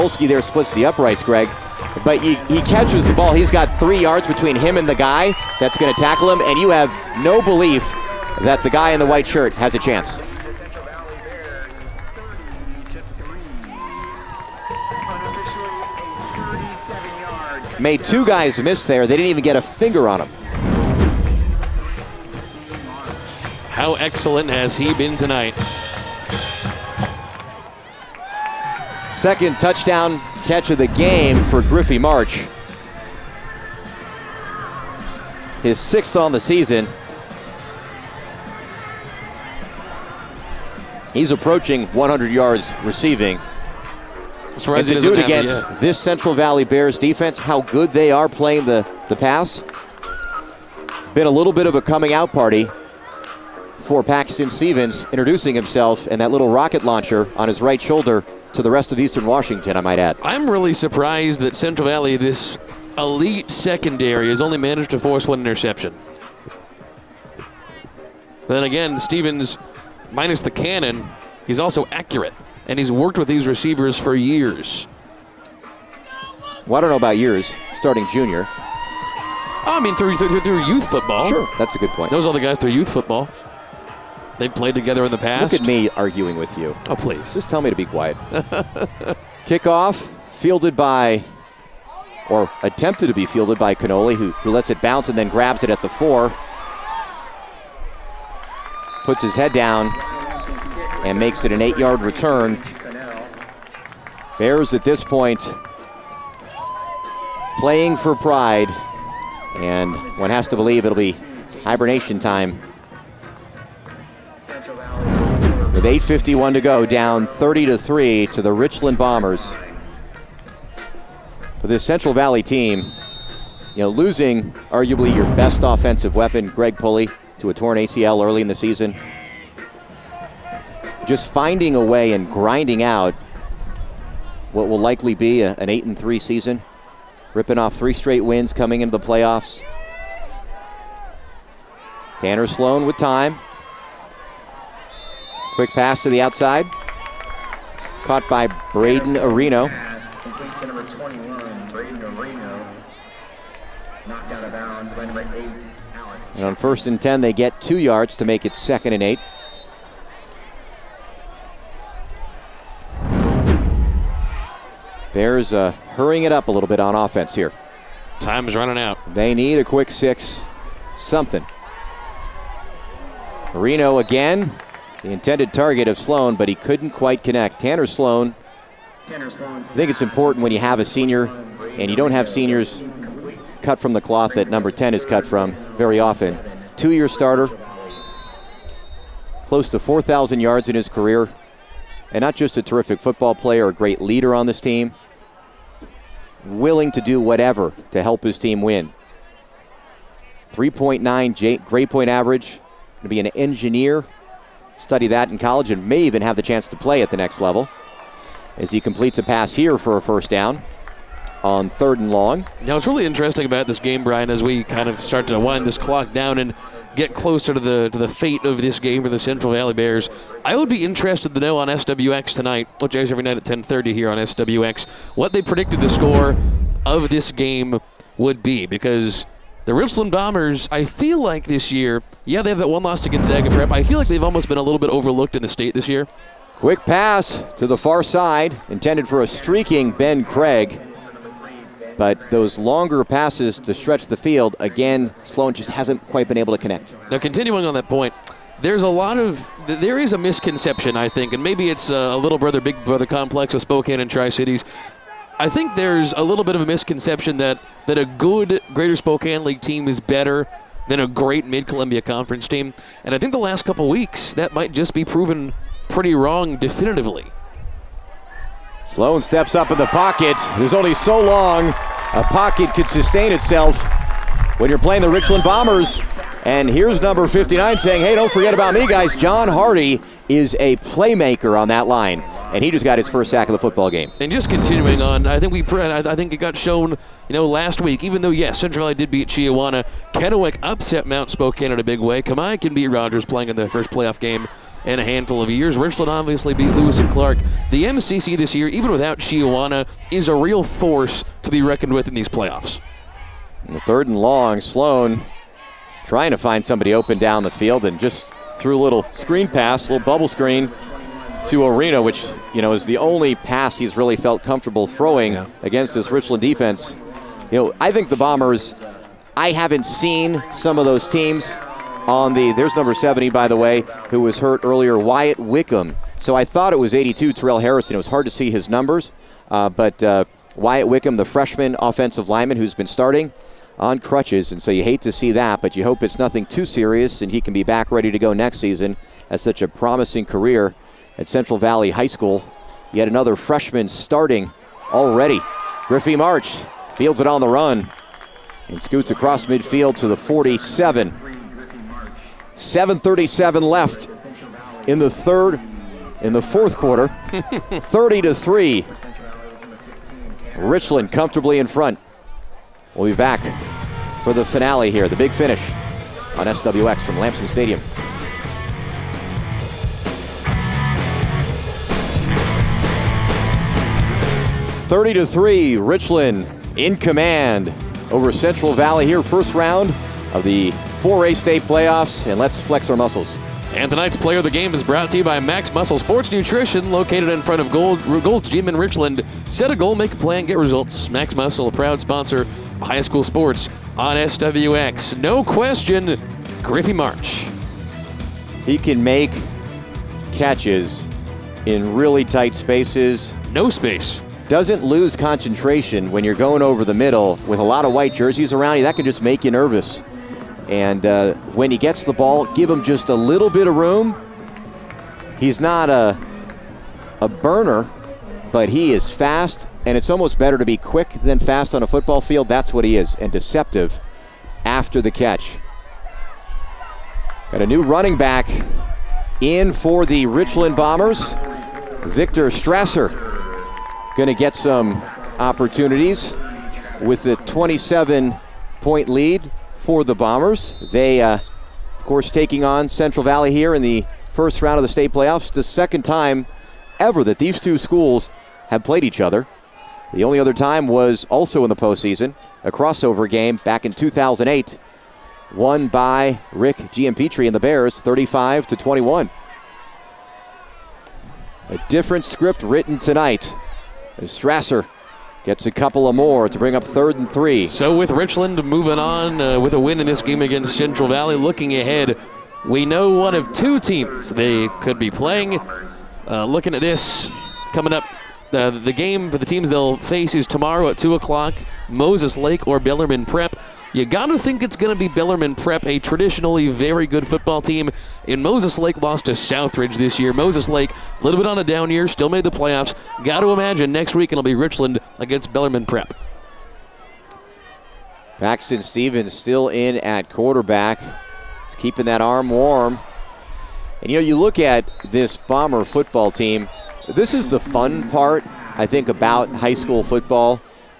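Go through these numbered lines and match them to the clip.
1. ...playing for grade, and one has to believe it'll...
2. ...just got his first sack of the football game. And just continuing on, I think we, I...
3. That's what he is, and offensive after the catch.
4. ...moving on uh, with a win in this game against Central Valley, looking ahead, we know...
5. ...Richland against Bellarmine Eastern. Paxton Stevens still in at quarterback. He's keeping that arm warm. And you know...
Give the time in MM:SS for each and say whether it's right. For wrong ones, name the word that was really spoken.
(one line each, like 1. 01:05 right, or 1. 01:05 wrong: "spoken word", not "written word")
1. 01:47 wrong: "pride", not "grade"
2. 04:42 right
3. 07:02 wrong: "deceptive", not "offensive"
4. 07:48 right
5. 08:14 wrong: "Prep", not "Eastern".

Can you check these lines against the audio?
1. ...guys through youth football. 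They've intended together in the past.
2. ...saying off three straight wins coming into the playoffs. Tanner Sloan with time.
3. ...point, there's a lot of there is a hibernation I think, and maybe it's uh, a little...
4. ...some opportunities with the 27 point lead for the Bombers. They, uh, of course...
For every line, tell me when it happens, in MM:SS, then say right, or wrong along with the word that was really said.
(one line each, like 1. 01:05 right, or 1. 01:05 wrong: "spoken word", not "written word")
1. 01:22 wrong: "played", not "intended"
2. 02:17 wrong: "ripping", not "saying"
3. 04:07 wrong: "misconception", not "hibernation"
4. 07:14 right.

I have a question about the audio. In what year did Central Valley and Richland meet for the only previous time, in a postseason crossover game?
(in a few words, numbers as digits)
2008.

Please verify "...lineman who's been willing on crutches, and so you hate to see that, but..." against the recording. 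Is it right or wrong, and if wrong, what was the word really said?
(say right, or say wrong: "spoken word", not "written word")
wrong: "starting", not "willing".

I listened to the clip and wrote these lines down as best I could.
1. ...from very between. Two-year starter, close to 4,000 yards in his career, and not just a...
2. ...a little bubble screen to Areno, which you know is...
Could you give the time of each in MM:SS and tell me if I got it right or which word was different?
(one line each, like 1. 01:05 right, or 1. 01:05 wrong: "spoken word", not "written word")
1. 03:05 wrong: "often", not "between"
2. 05:09 right.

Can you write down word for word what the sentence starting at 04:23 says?
And I think the last couple weeks, that might just be proven pretty wrong definitively.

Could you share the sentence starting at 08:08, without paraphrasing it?
And Moses Lake lost to Southridge this year.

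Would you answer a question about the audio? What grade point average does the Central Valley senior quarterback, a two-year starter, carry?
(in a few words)
3.9.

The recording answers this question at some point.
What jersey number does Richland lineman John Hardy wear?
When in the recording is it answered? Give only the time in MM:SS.
04:37.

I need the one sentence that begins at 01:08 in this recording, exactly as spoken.
then again, Stevens, minus the cannon, he's also accurate, and he's worked with these receivers for years.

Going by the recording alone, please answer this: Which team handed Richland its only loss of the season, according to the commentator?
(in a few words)
Gonzaga Prep.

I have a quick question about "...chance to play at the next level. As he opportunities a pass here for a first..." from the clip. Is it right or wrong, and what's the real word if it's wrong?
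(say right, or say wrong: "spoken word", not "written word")
wrong: "completes", not "opportunities".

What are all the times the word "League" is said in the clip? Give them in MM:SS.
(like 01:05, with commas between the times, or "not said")
04:19.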